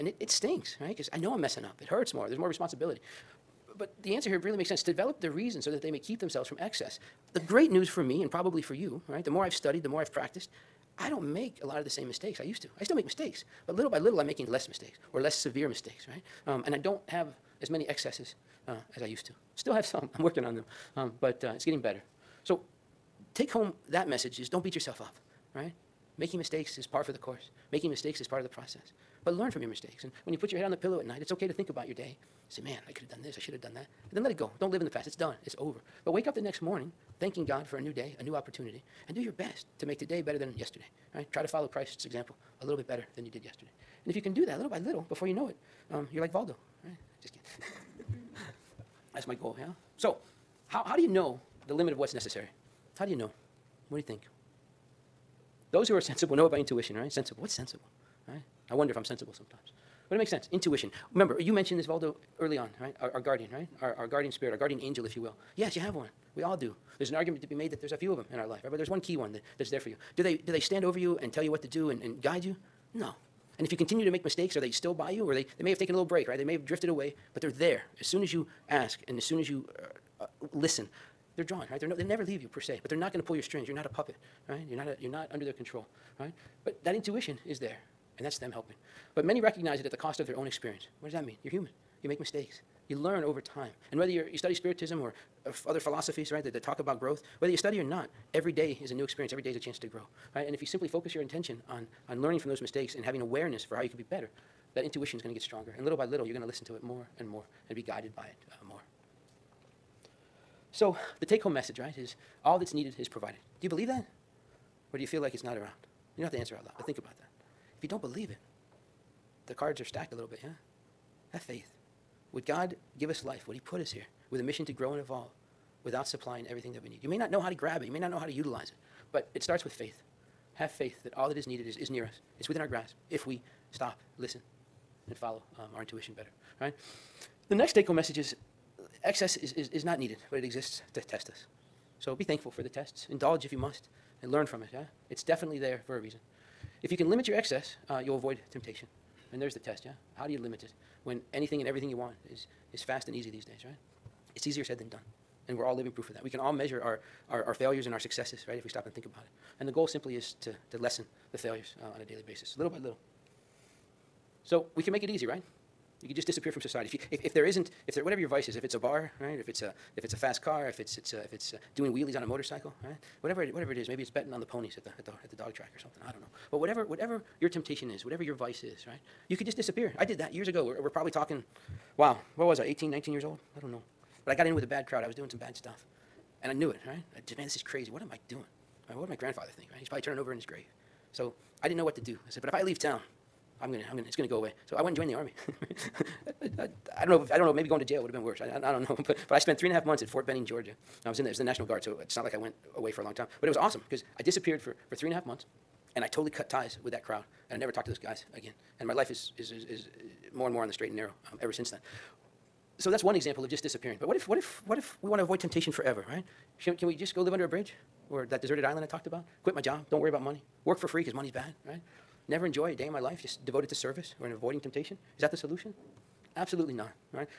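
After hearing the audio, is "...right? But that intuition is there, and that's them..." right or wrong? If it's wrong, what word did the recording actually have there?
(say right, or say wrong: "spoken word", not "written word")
right.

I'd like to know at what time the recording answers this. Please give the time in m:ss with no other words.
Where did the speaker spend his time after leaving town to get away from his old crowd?
3:20.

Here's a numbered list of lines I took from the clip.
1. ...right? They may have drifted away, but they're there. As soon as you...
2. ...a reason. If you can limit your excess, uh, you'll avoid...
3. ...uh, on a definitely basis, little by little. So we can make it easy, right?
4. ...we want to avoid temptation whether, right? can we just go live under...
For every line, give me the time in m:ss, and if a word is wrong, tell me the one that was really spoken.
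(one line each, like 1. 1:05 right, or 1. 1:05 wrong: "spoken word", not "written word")
1. 1:16 right
2. 2:25 right
3. 2:41 wrong: "daily", not "definitely"
4. 3:35 wrong: "forever", not "whether".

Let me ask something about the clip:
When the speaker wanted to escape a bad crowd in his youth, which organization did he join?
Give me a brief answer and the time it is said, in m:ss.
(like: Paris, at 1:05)
The army, at 3:14.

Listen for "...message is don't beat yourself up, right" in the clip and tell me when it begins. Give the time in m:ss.
0:24.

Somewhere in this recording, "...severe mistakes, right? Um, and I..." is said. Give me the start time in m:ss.
0:15.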